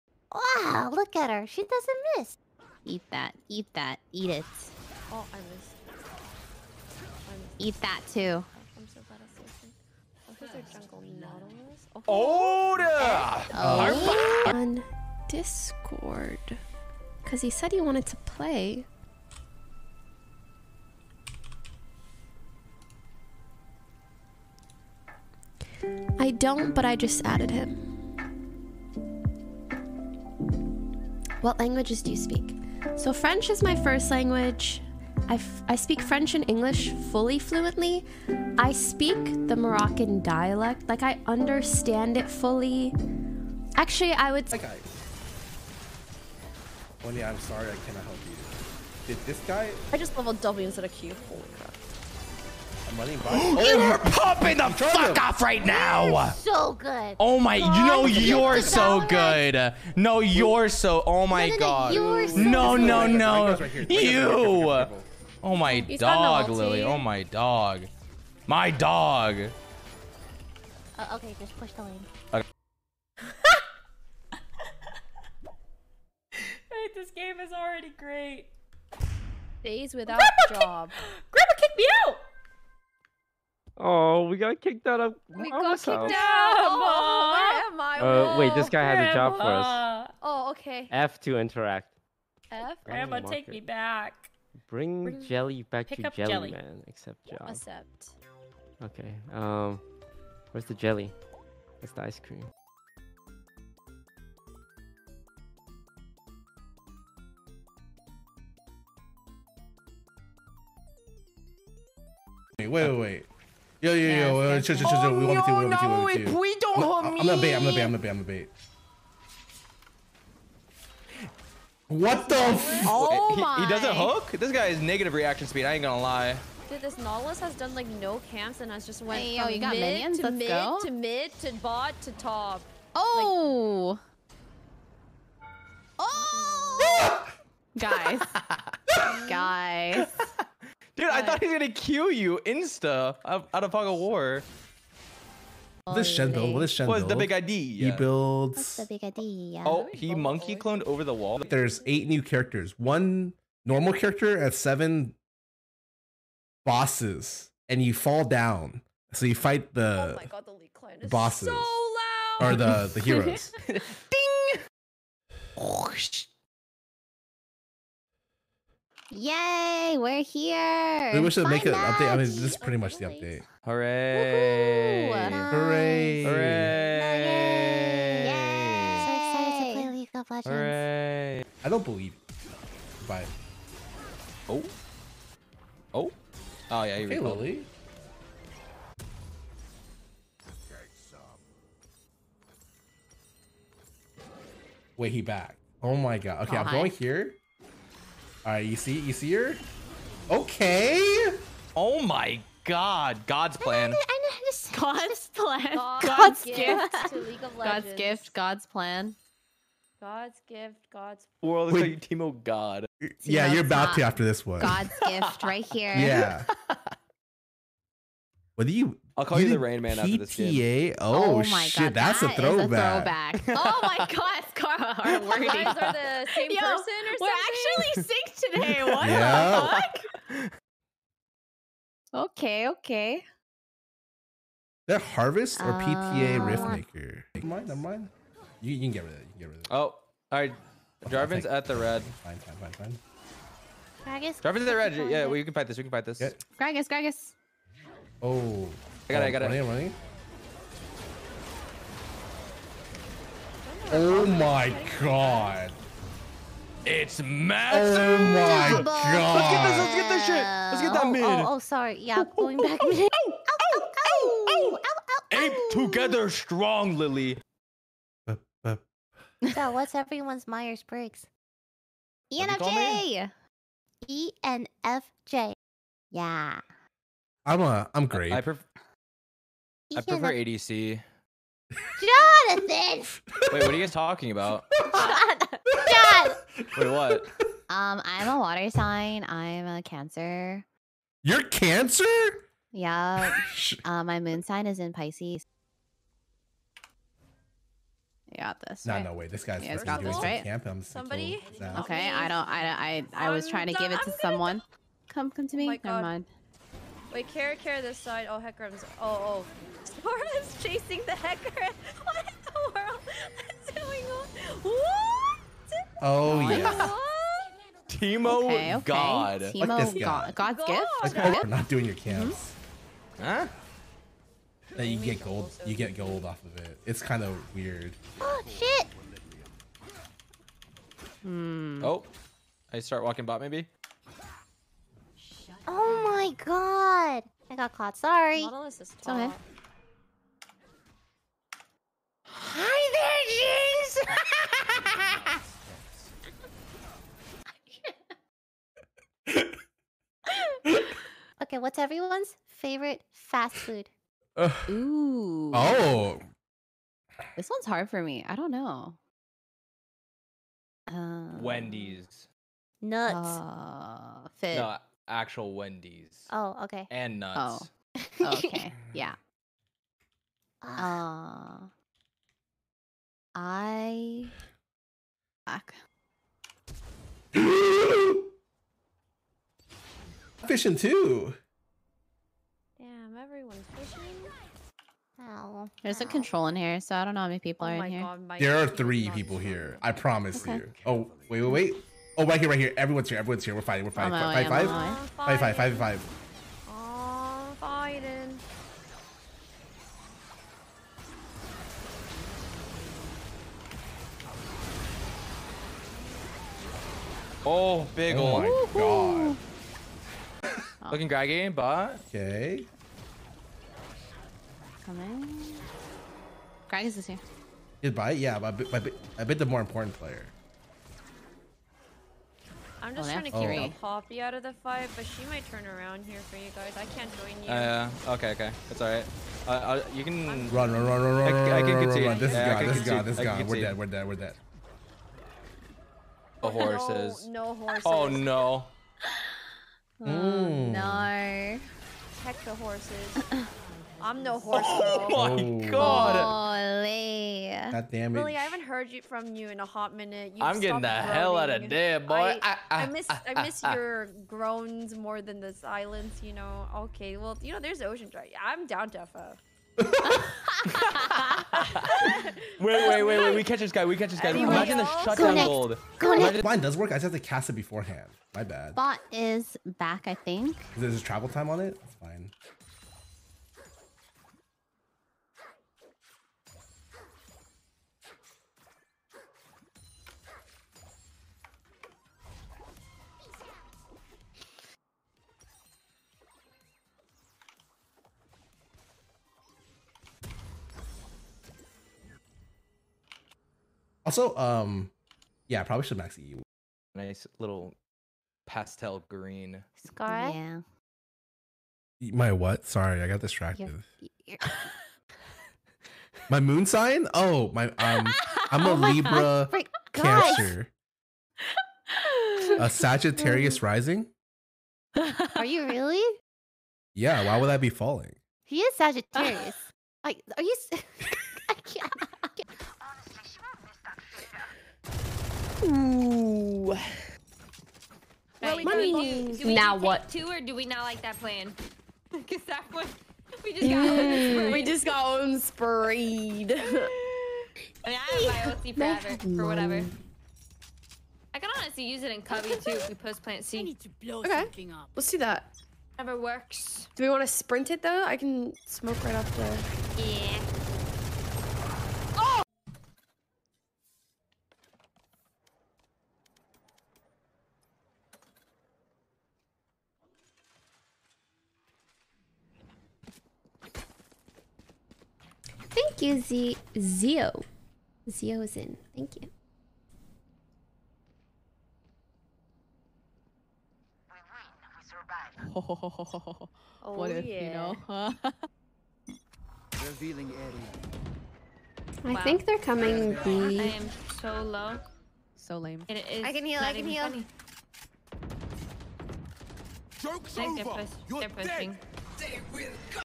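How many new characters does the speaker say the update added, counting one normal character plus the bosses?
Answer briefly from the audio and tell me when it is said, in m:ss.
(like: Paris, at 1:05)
Eight, at 2:31.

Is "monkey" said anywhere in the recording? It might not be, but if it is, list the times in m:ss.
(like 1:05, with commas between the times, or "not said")
2:30.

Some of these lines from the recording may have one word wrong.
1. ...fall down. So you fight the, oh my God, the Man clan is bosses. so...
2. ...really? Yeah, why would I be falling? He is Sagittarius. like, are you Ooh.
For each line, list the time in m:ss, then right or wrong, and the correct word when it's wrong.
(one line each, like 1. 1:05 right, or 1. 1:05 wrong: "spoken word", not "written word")
1. 2:37 wrong: "Lee", not "Man"
2. 8:35 right.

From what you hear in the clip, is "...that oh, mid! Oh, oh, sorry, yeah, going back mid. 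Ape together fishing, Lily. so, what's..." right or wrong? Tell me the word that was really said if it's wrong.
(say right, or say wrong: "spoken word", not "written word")
wrong: "strong", not "fishing".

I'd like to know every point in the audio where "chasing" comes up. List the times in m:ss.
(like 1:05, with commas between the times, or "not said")
5:10.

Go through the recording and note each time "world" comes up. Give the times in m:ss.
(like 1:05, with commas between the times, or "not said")
3:31, 5:12.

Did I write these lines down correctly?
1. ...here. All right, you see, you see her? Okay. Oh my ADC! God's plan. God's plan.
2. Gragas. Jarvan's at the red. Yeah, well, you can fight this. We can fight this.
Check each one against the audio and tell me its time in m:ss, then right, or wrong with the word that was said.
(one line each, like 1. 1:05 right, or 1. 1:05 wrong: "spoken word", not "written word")
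1. 3:16 wrong: "God", not "ADC"
2. 4:04 right.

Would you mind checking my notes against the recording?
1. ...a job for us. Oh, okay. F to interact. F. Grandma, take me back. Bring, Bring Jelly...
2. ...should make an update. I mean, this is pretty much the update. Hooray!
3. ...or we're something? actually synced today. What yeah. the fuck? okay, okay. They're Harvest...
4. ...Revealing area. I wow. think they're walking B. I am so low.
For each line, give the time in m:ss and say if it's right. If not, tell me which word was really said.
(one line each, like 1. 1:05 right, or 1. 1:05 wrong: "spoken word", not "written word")
1. 1:29 right
2. 2:51 right
3. 3:47 right
4. 9:39 wrong: "coming", not "walking".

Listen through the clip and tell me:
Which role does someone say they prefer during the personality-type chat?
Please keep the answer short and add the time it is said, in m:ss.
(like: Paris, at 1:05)
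ADC, at 4:39.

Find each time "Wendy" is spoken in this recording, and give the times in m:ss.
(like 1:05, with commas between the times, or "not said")
6:01, 6:05.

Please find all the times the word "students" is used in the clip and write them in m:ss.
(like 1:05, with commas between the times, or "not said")
not said.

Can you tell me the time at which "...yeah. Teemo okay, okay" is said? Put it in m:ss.
5:16.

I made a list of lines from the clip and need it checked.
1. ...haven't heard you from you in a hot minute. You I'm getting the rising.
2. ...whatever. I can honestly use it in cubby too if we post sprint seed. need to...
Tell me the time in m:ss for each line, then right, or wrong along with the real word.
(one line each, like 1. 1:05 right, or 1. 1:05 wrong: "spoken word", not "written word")
1. 7:28 wrong: "groaning", not "rising"
2. 8:59 wrong: "plant", not "sprint".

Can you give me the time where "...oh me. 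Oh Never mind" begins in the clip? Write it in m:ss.
5:05.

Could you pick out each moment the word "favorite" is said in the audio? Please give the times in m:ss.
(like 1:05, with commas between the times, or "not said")
5:52.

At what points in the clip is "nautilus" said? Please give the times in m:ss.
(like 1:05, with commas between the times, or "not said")
0:11, 2:06, 5:38.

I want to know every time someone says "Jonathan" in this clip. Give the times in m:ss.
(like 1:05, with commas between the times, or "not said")
4:42.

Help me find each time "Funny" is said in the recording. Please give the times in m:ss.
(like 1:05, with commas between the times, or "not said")
9:47.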